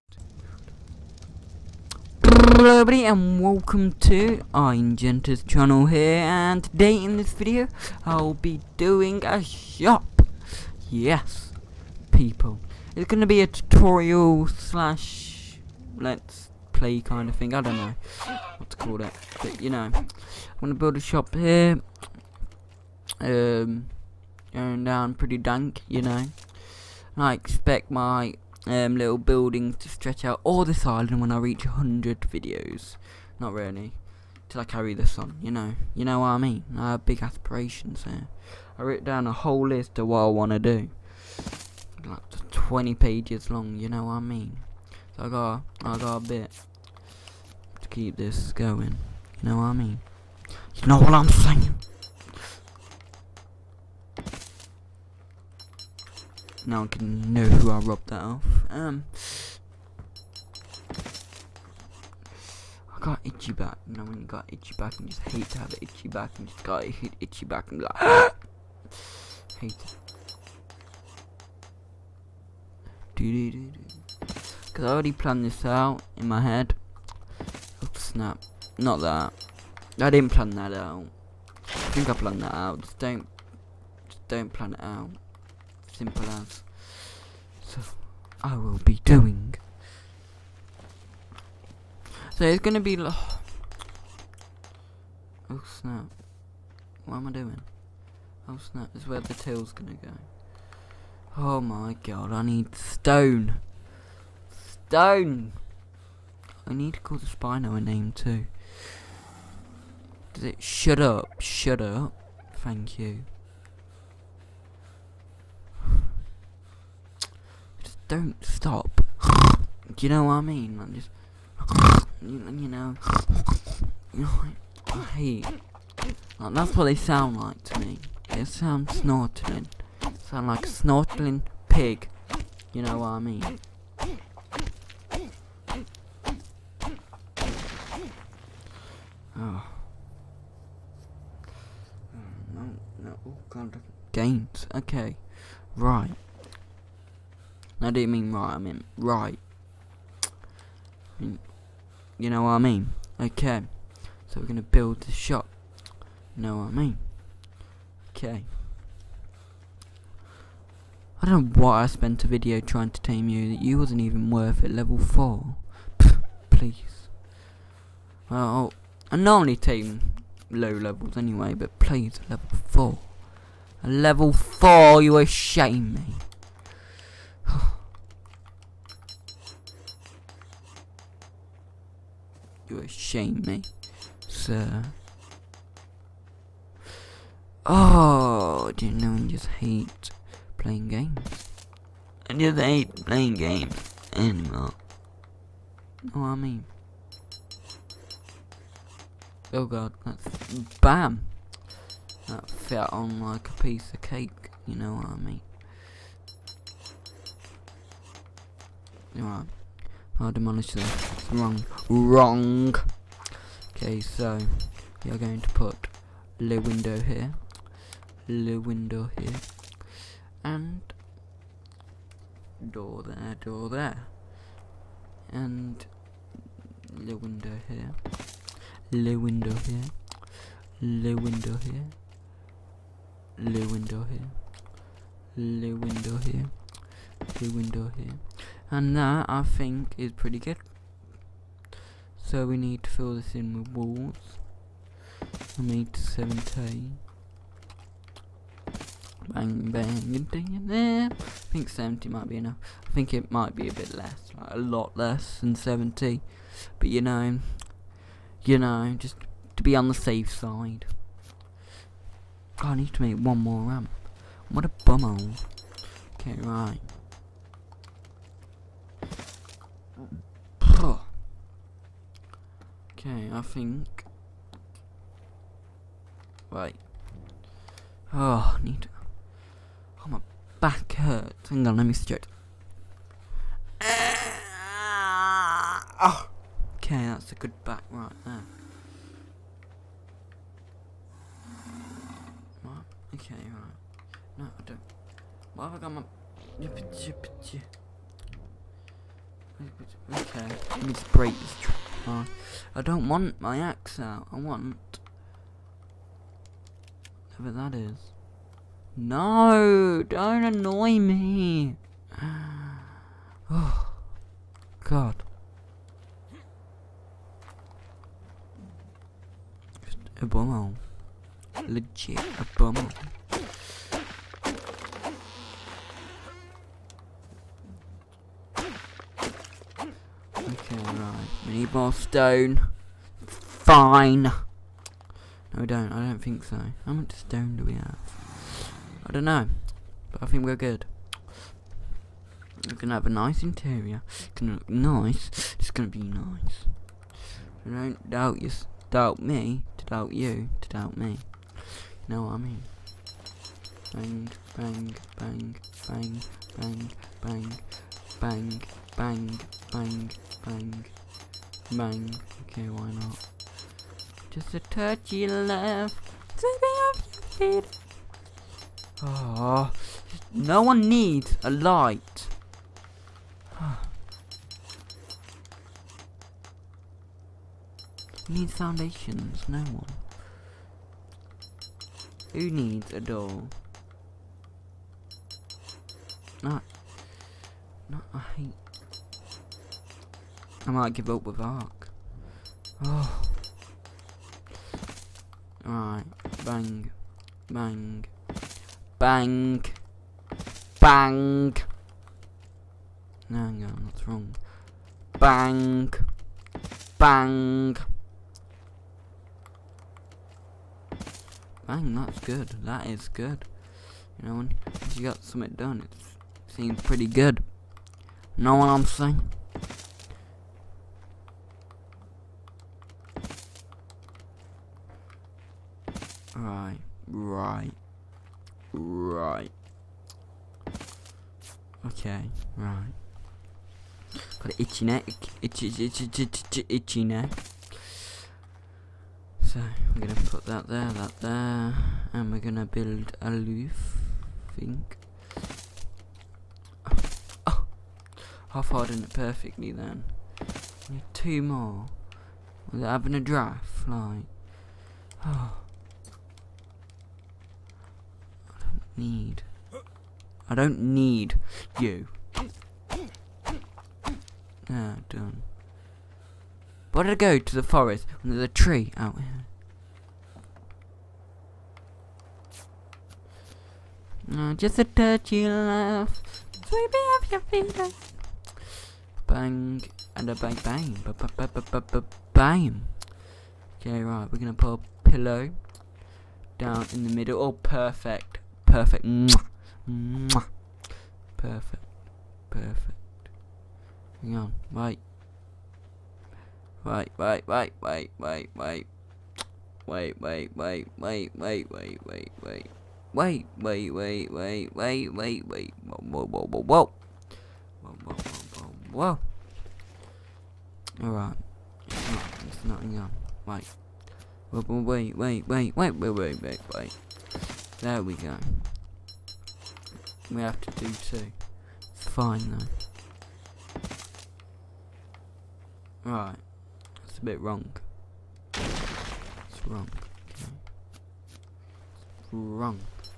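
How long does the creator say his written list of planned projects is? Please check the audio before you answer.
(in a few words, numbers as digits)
20 pages.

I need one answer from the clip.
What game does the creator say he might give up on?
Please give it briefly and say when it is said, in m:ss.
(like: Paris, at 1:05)
Ark, at 6:31.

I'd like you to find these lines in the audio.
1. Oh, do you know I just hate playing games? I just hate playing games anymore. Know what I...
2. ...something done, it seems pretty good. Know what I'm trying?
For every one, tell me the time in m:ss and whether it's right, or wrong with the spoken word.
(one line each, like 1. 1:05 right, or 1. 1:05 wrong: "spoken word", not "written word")
1. 3:07 right
2. 6:55 wrong: "saying", not "trying".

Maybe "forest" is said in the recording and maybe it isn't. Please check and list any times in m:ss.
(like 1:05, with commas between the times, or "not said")
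7:47.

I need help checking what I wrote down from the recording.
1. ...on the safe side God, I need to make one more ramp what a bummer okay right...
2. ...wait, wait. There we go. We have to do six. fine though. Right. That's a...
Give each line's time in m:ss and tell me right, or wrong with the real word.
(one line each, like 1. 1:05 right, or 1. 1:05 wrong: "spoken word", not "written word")
1. 4:19 right
2. 8:36 wrong: "two", not "six".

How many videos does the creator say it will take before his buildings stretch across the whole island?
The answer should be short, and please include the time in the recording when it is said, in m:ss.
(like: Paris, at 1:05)
100, at 0:31.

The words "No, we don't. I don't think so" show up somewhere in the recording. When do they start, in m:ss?
5:34.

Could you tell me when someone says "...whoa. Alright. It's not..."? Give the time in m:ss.
8:31.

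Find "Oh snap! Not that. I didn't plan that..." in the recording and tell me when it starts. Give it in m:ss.
1:17.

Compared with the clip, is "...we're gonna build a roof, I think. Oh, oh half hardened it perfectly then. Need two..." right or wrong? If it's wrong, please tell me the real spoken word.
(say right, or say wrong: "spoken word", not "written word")
right.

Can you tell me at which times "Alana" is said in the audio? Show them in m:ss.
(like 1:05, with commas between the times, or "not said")
not said.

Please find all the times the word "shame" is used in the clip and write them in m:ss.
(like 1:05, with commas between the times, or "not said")
2:55, 3:02.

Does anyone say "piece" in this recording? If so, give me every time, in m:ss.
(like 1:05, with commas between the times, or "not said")
3:23.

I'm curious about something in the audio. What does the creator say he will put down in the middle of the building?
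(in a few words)
A pillow.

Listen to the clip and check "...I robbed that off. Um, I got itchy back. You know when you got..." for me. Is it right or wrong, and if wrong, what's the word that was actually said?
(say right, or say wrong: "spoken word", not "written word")
right.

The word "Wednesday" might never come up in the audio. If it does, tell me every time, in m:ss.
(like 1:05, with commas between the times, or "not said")
not said.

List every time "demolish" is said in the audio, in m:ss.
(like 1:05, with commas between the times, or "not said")
3:30.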